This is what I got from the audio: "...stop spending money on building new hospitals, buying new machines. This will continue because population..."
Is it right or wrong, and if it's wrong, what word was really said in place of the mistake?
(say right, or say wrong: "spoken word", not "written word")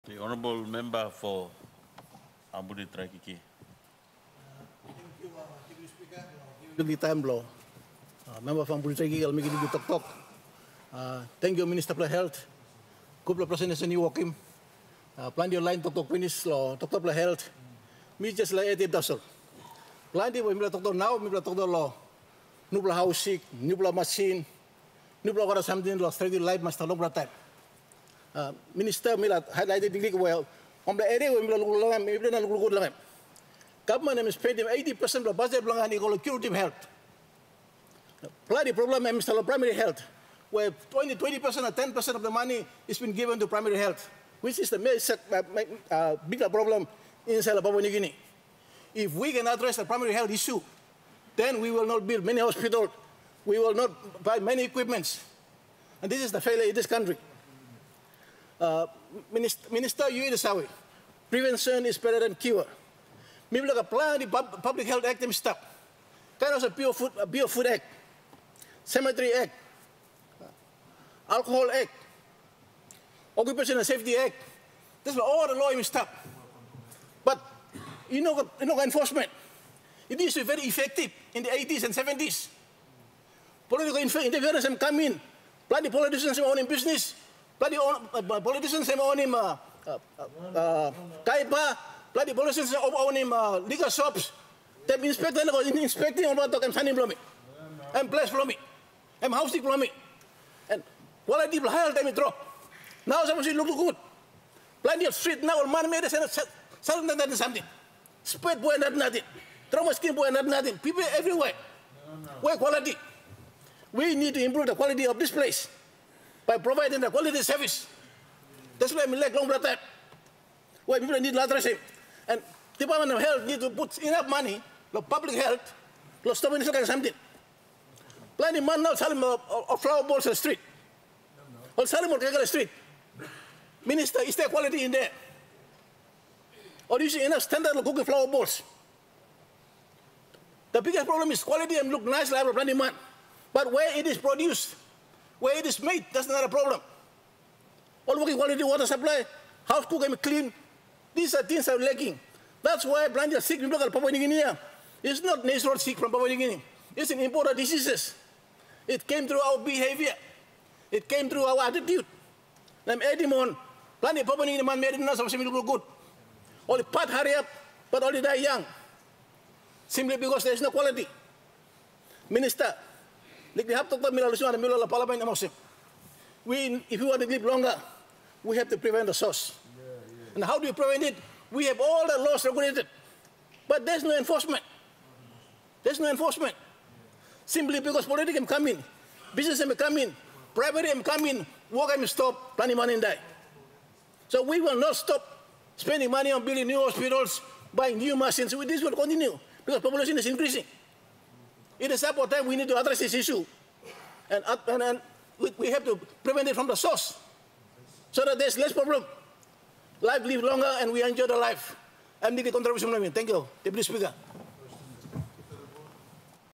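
right.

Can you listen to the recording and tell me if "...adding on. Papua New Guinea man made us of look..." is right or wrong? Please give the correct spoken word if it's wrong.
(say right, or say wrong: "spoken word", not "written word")
right.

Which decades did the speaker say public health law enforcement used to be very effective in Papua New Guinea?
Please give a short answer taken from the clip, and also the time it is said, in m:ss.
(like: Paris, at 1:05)
80s and 70s, at 1:21.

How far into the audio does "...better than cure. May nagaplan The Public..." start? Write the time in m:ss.
1:01.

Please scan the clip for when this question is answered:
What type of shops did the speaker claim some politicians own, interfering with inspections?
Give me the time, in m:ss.
1:33.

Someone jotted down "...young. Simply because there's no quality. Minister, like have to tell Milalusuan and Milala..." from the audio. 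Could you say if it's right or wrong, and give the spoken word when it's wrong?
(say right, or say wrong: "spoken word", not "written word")
right.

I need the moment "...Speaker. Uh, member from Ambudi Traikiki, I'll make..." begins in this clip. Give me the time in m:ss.
0:06.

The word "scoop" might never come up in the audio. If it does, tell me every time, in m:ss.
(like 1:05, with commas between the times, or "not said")
not said.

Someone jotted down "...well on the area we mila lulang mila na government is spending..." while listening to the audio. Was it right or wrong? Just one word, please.
right.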